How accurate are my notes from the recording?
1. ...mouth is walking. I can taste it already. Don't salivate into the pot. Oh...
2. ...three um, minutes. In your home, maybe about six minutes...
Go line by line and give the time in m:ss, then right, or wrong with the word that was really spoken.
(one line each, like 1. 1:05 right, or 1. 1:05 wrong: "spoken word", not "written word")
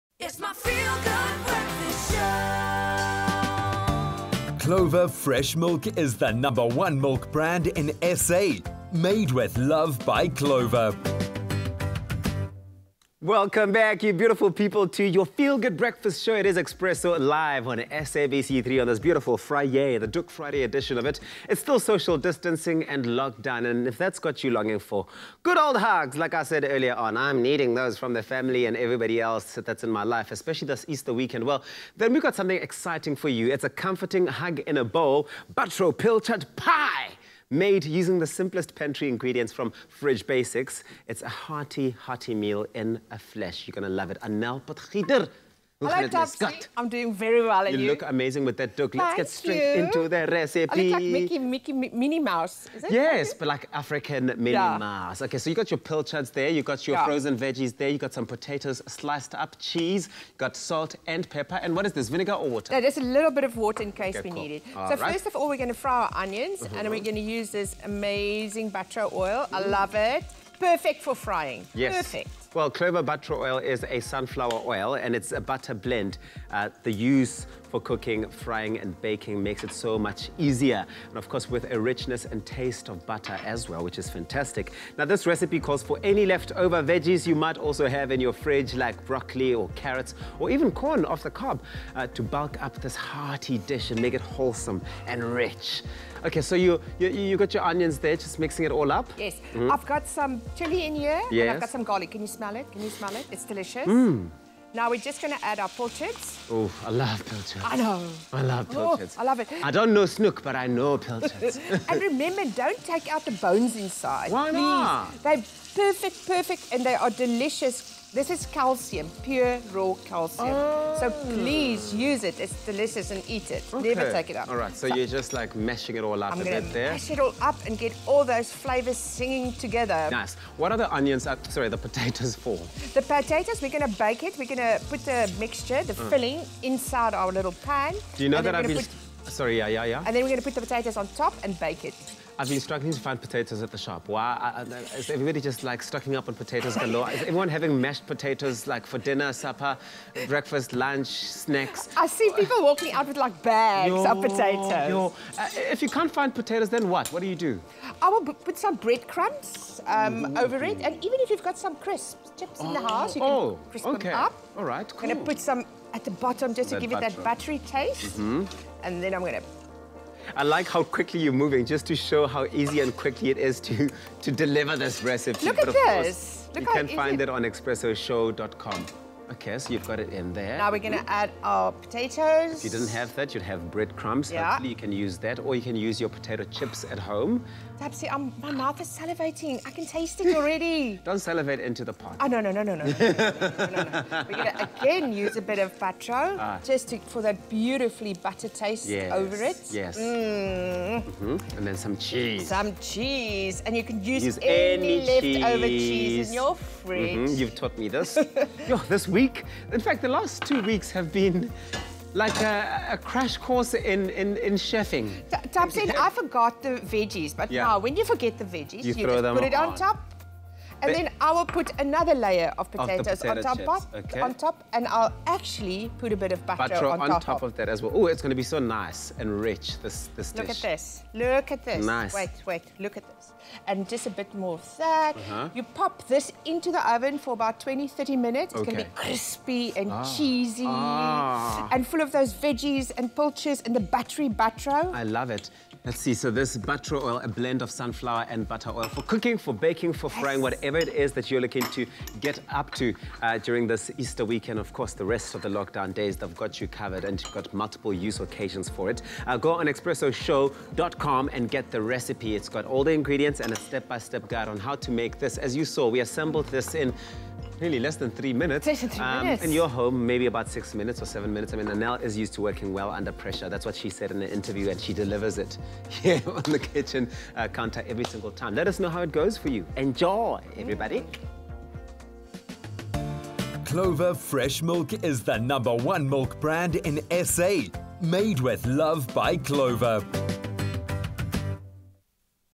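1. 3:08 wrong: "salivating", not "walking"
2. 4:28 right.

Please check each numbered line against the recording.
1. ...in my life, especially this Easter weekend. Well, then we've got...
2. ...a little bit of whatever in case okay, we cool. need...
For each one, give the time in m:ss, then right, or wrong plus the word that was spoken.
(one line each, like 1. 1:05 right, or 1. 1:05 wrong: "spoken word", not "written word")
1. 0:29 right
2. 1:02 wrong: "water", not "whatever".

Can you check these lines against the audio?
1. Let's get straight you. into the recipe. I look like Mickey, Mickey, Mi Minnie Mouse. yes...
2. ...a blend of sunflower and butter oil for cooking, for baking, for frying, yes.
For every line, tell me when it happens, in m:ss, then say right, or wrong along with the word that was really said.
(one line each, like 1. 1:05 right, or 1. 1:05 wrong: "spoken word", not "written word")
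1. 0:48 right
2. 4:07 right.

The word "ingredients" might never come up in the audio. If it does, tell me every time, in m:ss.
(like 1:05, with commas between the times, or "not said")
0:39, 4:22.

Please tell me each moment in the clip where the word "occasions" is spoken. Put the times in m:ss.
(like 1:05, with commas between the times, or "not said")
4:18.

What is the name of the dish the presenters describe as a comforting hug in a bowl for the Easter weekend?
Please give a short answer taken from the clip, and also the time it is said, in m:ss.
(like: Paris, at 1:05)
Butro Pilchard Pie, at 0:35.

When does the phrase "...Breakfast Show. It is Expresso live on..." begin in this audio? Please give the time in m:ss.
0:15.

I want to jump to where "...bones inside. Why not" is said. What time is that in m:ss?
1:53.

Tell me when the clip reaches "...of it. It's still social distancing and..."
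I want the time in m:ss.
0:20.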